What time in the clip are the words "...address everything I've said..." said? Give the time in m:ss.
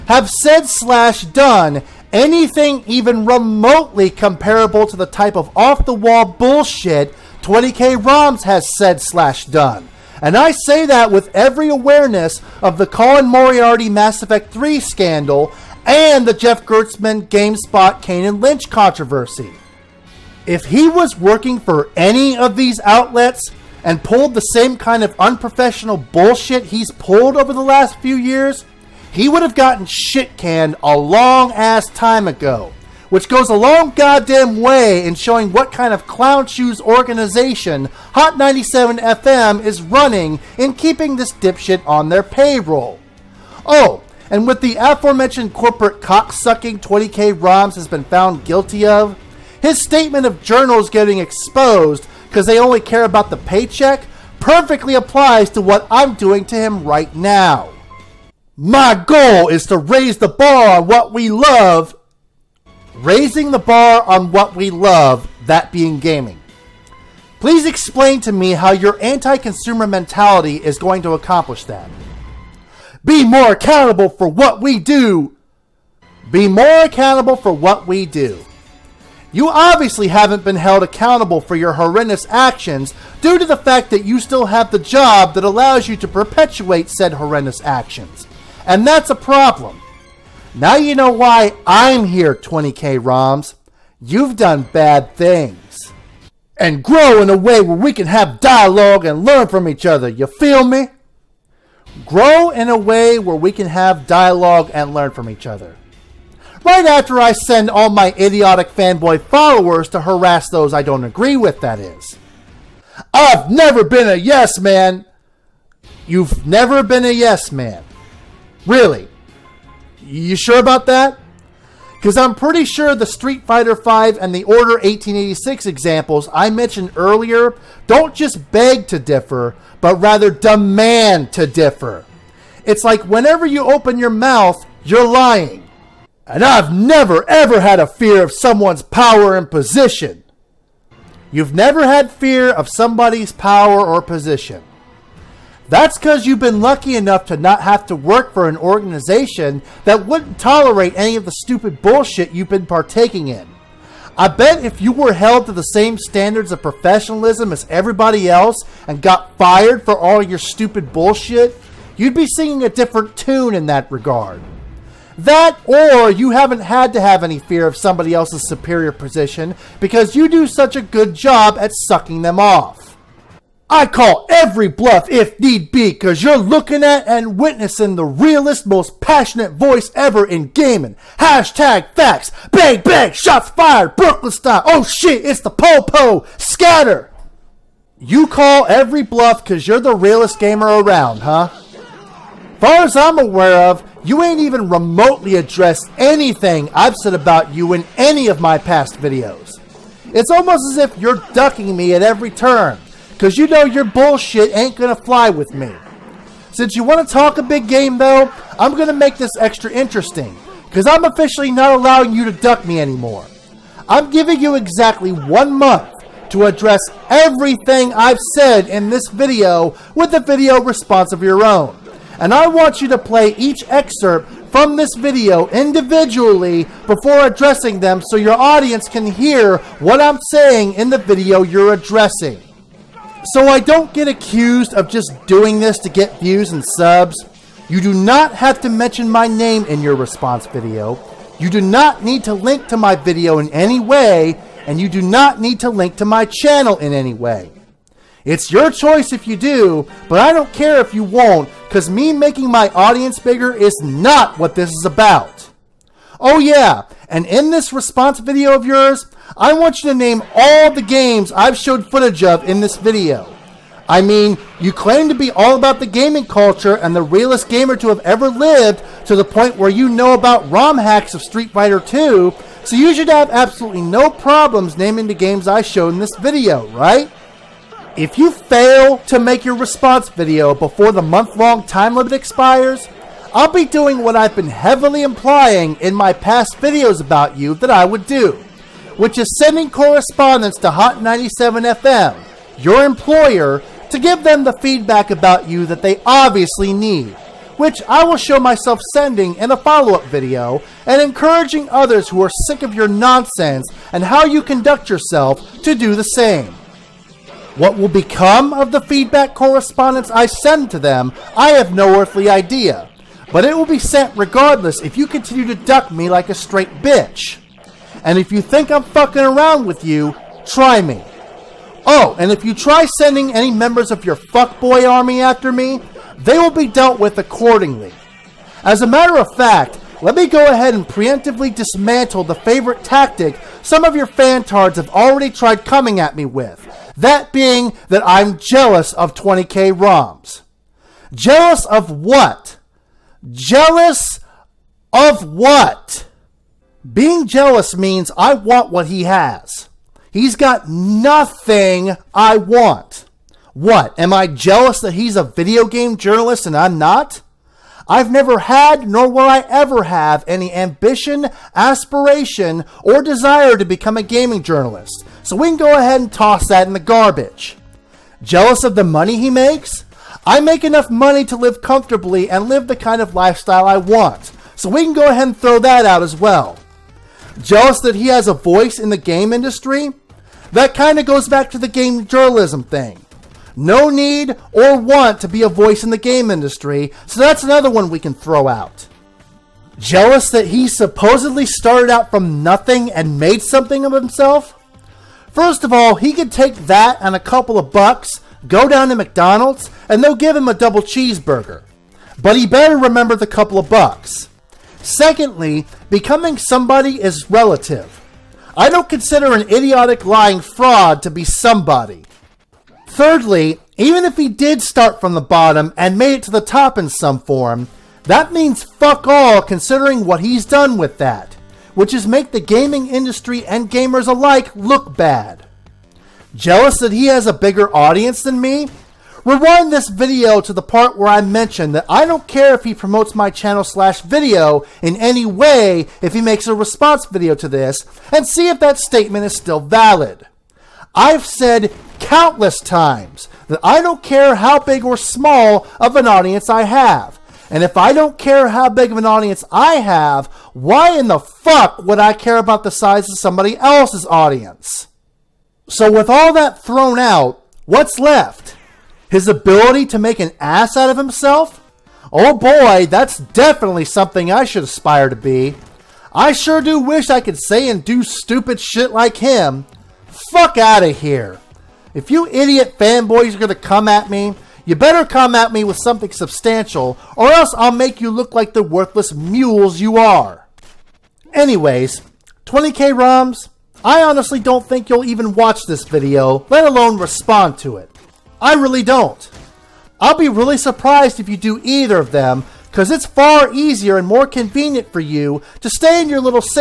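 3:36.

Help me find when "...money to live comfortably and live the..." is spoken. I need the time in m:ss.
6:10.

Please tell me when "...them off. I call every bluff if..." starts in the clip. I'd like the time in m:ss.
2:52.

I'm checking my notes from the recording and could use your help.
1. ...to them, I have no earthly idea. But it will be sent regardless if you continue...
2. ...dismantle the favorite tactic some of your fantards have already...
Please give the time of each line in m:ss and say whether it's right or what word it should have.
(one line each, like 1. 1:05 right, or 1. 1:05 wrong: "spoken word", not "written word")
1. 5:10 right
2. 5:31 right.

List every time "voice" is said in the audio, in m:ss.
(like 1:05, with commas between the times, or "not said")
2:59, 6:18, 6:25.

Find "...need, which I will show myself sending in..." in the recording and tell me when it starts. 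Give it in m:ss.
4:56.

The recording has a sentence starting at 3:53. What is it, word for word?
So I don't get accused of just doing this to get views and subs.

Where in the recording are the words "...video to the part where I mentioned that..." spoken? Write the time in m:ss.
7:09.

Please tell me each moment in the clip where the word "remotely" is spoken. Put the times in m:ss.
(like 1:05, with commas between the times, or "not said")
0:03, 3:14.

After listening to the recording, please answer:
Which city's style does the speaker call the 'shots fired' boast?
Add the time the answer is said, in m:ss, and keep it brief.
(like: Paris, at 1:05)
Brooklyn, at 3:03.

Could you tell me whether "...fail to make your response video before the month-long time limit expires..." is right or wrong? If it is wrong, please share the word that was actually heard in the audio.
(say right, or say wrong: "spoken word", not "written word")
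right.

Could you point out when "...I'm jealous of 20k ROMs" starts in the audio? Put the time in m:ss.
5:38.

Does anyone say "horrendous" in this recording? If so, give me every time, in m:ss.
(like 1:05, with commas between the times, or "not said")
1:21, 1:27.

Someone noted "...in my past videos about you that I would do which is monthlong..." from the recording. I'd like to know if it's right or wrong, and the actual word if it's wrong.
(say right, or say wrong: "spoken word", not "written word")
wrong: "sending", not "monthlong".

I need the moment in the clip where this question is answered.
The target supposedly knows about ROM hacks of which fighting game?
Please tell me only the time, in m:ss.
4:31.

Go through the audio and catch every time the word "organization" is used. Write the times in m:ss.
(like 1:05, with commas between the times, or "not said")
0:36, 2:28.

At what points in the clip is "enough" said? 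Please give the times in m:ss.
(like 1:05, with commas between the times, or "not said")
2:26, 6:10.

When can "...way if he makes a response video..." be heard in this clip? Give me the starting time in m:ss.
7:15.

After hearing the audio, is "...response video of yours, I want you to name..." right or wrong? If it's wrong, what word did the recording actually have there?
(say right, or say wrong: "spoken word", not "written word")
right.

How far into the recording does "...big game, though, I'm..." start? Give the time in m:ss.
3:27.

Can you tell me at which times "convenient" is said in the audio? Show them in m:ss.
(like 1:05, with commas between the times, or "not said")
8:14.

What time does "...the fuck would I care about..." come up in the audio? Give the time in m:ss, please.
7:31.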